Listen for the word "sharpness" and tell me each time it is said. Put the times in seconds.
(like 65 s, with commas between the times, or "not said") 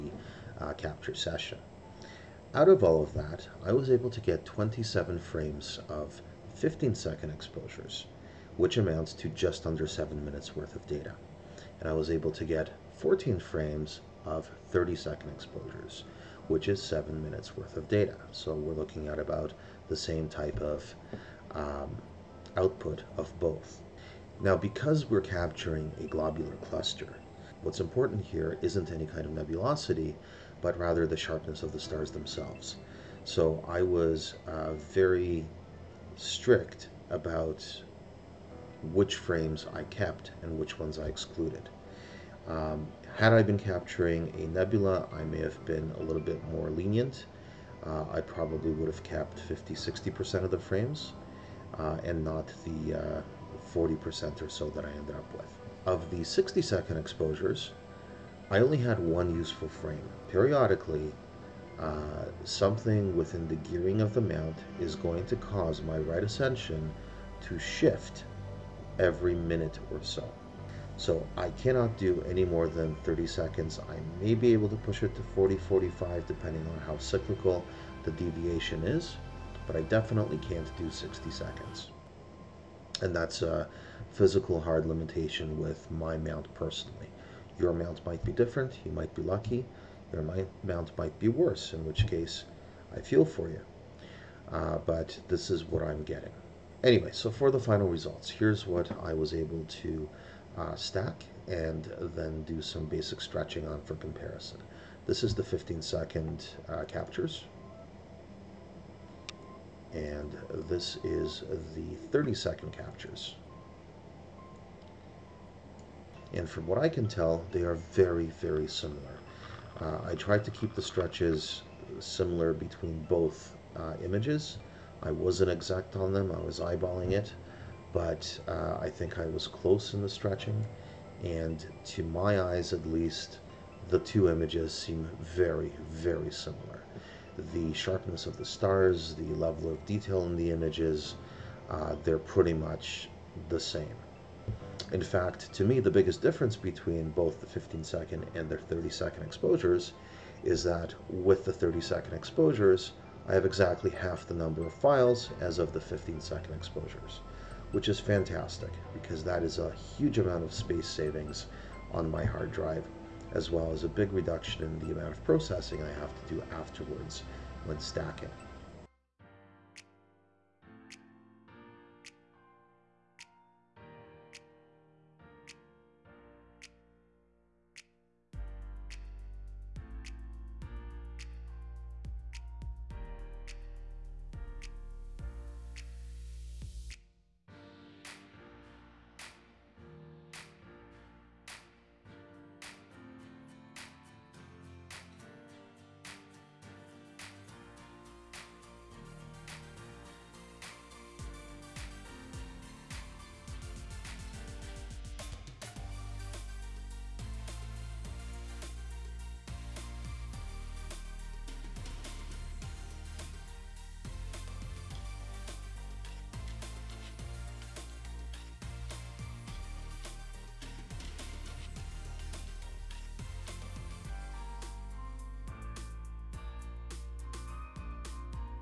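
31 s, 137 s.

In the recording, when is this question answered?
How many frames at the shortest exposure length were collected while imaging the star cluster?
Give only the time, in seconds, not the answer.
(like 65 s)
4 s.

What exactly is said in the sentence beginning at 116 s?
And from what I can tell, they are very, very similar.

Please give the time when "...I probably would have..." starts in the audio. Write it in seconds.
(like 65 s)
48 s.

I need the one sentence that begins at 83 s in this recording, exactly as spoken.
And that's a physical hard limitation with my mount personally.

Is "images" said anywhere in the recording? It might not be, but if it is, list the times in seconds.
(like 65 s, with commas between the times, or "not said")
124 s, 134 s, 140 s.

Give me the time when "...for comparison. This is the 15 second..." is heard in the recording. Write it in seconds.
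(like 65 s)
103 s.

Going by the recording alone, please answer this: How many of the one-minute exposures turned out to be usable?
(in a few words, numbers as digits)
1.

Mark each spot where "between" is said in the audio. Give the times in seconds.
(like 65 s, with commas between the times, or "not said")
122 s, 146 s.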